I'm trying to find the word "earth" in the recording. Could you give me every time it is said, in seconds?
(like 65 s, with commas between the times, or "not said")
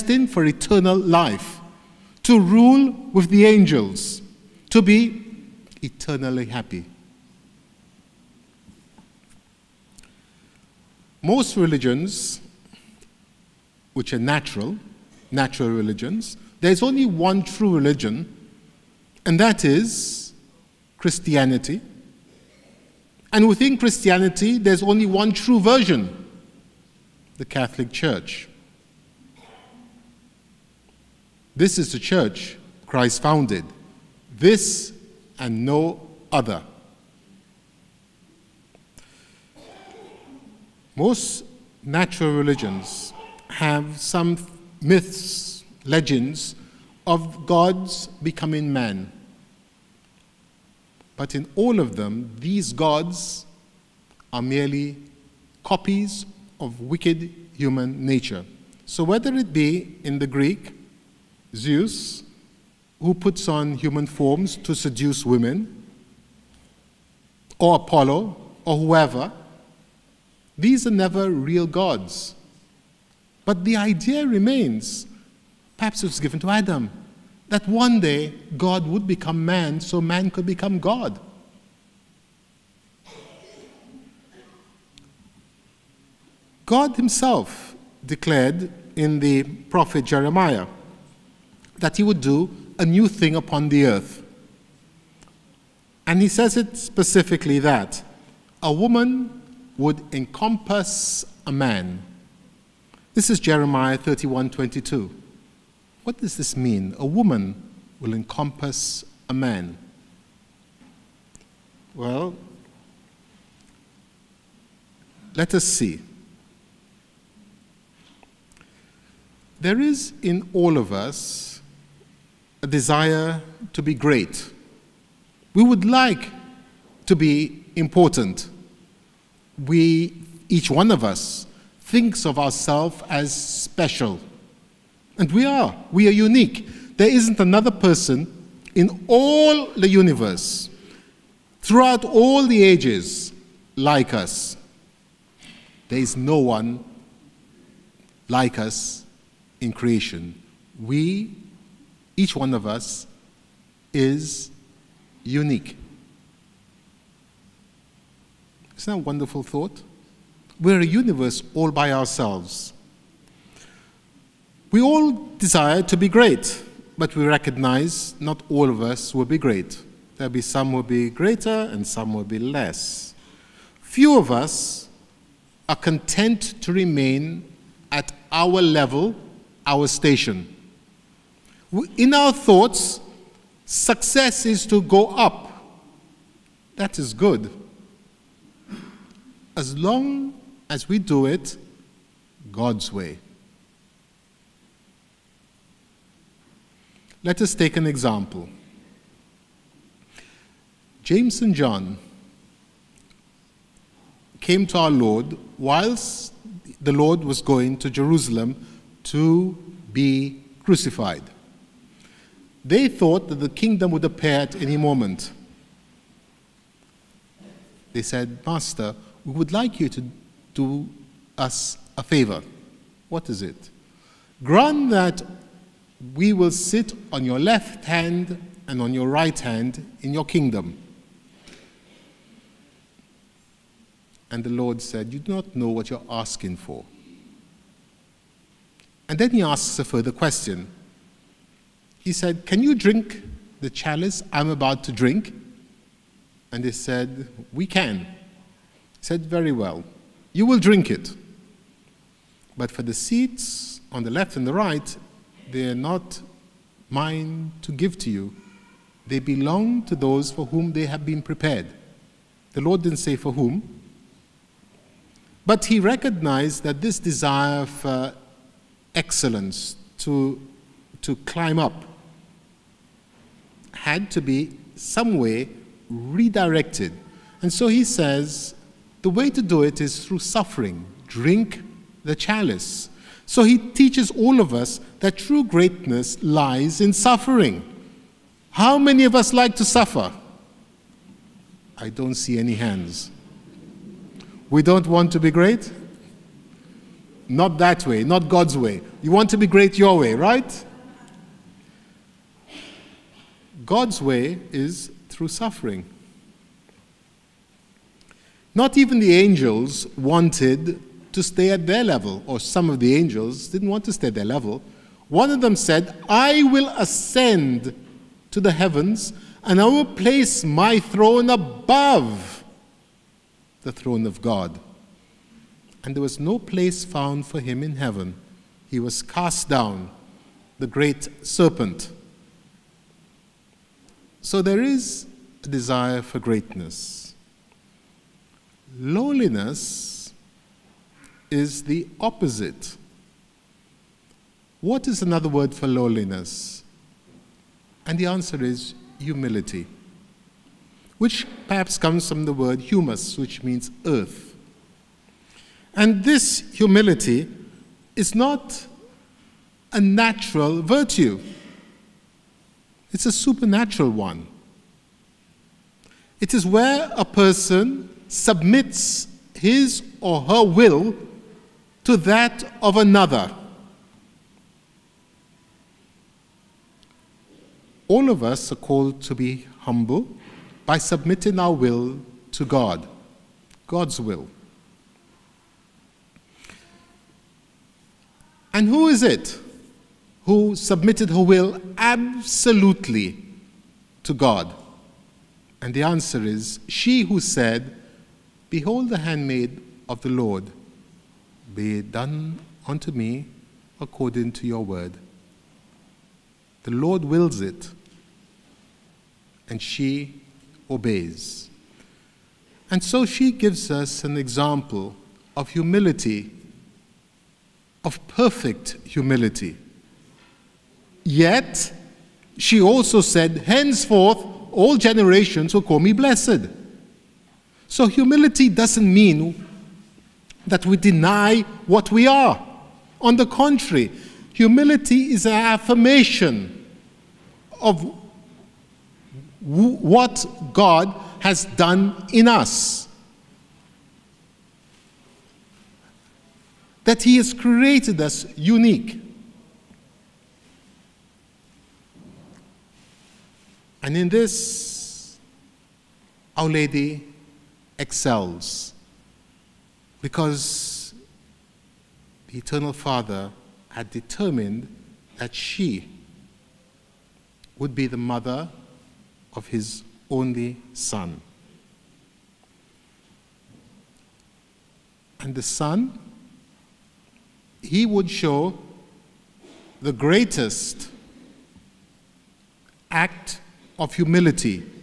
93 s, 353 s.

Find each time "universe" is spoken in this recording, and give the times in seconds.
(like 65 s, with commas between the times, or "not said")
139 s, 160 s.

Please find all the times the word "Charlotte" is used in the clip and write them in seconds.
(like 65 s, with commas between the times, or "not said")
not said.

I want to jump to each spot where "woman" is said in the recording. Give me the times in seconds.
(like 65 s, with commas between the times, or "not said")
98 s, 107 s.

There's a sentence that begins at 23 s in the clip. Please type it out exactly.
And within Christianity, there's only one true version the Catholic Church.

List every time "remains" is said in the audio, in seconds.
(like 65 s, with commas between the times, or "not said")
74 s, 176 s.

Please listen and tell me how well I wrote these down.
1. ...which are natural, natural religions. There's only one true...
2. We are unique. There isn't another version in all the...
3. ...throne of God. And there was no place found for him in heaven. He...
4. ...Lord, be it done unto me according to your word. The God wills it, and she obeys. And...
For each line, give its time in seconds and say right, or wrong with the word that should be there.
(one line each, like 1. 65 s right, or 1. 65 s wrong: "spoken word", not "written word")
1. 13 s right
2. 135 s wrong: "person", not "version"
3. 323 s right
4. 400 s wrong: "Lord", not "God".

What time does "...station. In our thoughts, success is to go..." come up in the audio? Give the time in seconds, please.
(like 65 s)
179 s.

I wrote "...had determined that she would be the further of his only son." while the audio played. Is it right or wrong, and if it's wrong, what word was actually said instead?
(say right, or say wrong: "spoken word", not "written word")
wrong: "mother", not "further".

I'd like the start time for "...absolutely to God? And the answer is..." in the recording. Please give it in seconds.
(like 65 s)
391 s.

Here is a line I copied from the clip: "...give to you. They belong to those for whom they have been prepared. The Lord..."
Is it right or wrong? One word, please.
right.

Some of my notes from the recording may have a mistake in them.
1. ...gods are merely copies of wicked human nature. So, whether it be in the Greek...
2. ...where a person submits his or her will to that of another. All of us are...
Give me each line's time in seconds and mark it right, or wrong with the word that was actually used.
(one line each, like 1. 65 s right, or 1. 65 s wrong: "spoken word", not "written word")
1. 52 s right
2. 366 s right.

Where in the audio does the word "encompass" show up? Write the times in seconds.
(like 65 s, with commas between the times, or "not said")
100 s, 108 s.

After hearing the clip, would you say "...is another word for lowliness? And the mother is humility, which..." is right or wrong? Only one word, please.
wrong.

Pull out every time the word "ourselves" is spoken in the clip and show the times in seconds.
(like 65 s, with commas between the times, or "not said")
132 s, 161 s.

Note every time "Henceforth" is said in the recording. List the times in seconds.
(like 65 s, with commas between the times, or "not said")
423 s.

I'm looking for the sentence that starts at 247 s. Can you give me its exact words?
He said, Very well you will drink it.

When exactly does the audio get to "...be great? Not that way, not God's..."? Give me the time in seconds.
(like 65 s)
295 s.